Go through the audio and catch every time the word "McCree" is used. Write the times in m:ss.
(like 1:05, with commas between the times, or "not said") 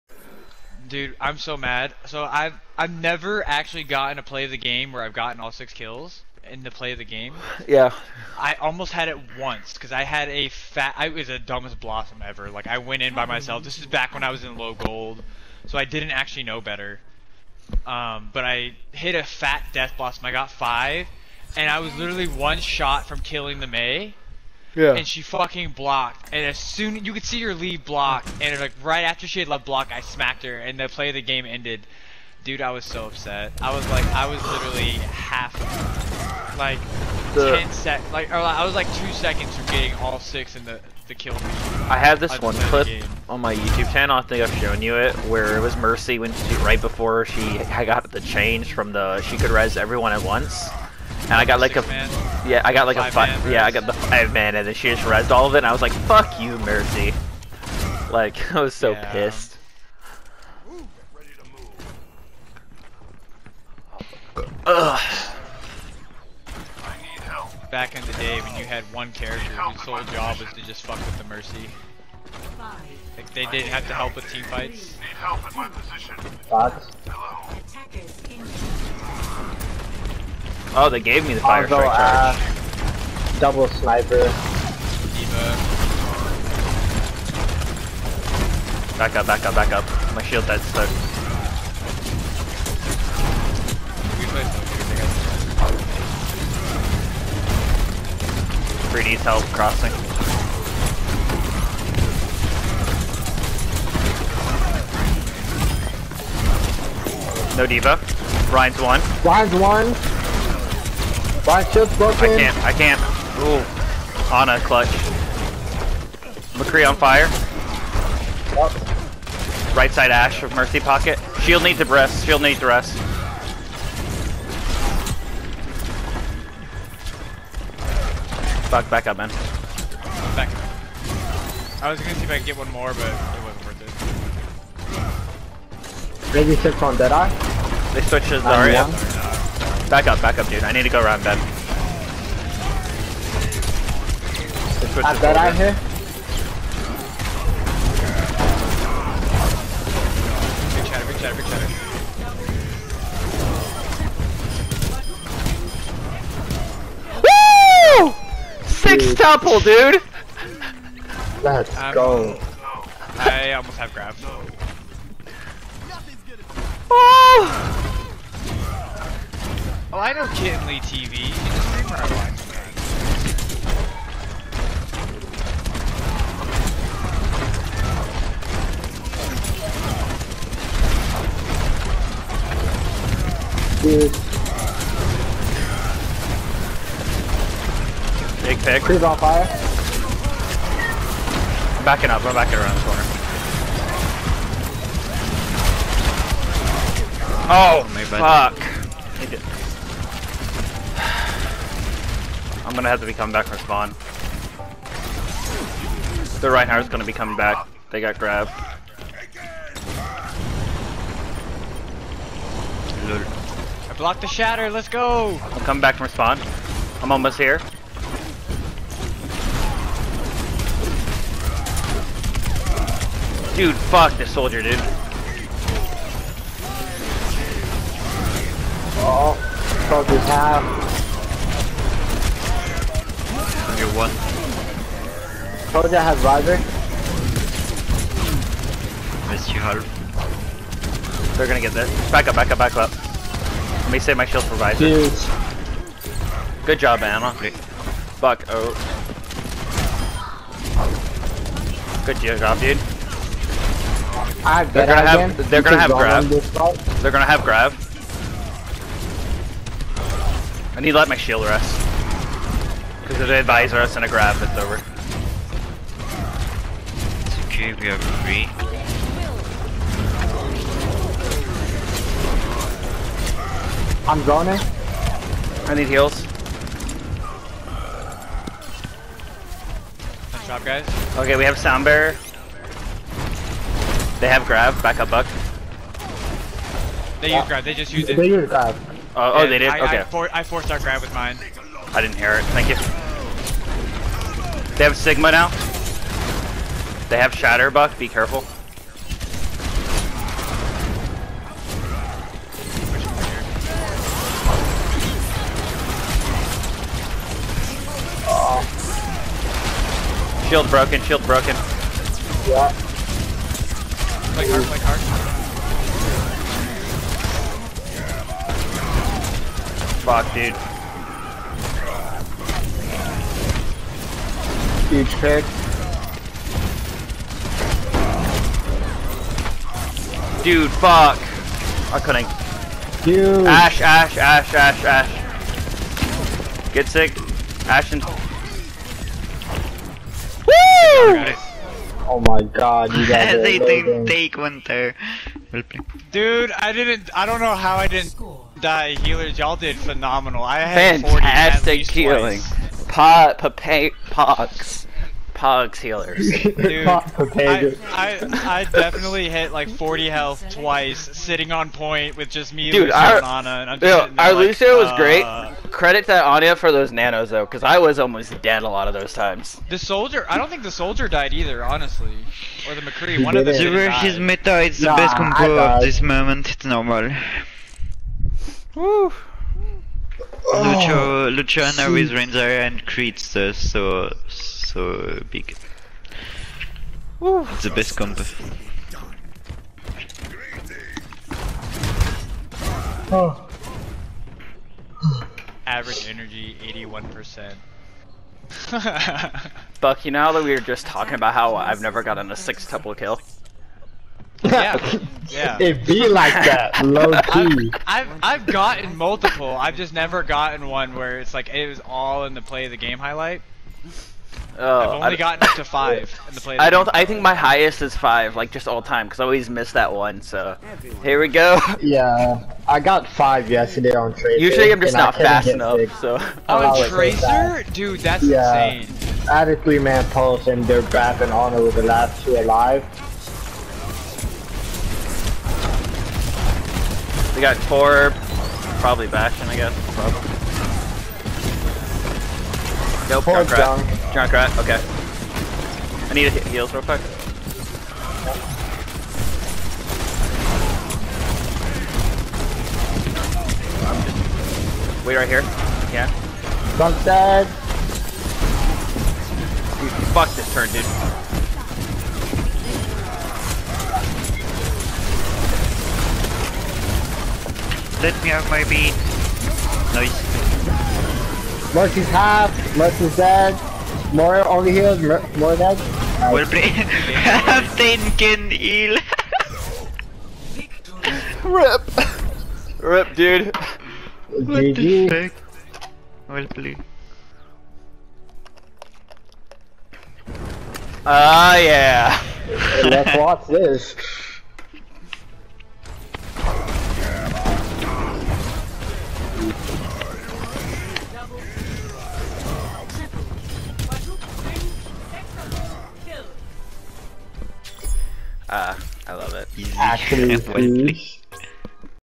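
1:56, 6:12.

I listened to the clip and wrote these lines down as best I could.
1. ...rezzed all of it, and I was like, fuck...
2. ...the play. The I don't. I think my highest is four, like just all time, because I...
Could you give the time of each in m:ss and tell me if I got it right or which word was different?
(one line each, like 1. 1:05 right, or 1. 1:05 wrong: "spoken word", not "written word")
1. 0:55 right
2. 6:56 wrong: "five", not "four".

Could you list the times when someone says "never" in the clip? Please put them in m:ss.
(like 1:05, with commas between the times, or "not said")
0:02, 6:41, 6:49.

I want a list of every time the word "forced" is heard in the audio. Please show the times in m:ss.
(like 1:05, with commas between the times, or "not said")
4:50.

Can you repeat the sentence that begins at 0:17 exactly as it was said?
Um, but I hit a fat death blossom.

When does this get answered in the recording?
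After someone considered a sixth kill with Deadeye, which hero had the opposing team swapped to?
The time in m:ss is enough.
2:18.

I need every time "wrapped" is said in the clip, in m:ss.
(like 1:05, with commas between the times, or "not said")
not said.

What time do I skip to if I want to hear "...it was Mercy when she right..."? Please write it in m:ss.
0:45.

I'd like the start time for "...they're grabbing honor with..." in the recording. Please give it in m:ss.
7:10.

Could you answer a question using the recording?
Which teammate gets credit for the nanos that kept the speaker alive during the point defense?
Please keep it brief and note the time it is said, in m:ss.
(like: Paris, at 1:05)
Anya, at 6:06.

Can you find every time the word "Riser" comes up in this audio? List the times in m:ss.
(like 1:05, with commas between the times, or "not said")
3:56, 4:04.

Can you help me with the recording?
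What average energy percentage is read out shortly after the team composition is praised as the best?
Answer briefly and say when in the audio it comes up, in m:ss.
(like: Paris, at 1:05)
81%, at 6:36.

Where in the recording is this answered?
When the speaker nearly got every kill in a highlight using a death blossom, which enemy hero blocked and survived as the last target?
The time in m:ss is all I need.
0:23.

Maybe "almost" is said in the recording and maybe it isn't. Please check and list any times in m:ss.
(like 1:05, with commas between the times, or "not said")
0:08, 2:43, 3:37, 6:07.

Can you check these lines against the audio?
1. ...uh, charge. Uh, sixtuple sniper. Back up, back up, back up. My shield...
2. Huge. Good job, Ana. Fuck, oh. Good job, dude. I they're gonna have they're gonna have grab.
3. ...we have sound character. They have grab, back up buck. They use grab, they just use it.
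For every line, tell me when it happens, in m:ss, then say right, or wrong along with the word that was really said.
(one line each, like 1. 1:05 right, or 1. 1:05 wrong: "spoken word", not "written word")
1. 1:21 wrong: "double", not "sixtuple"
2. 4:04 right
3. 4:41 wrong: "barrier", not "character".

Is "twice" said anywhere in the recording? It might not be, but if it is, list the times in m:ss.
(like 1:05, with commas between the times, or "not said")
5:52, 6:00.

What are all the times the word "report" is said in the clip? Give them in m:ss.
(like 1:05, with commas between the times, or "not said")
not said.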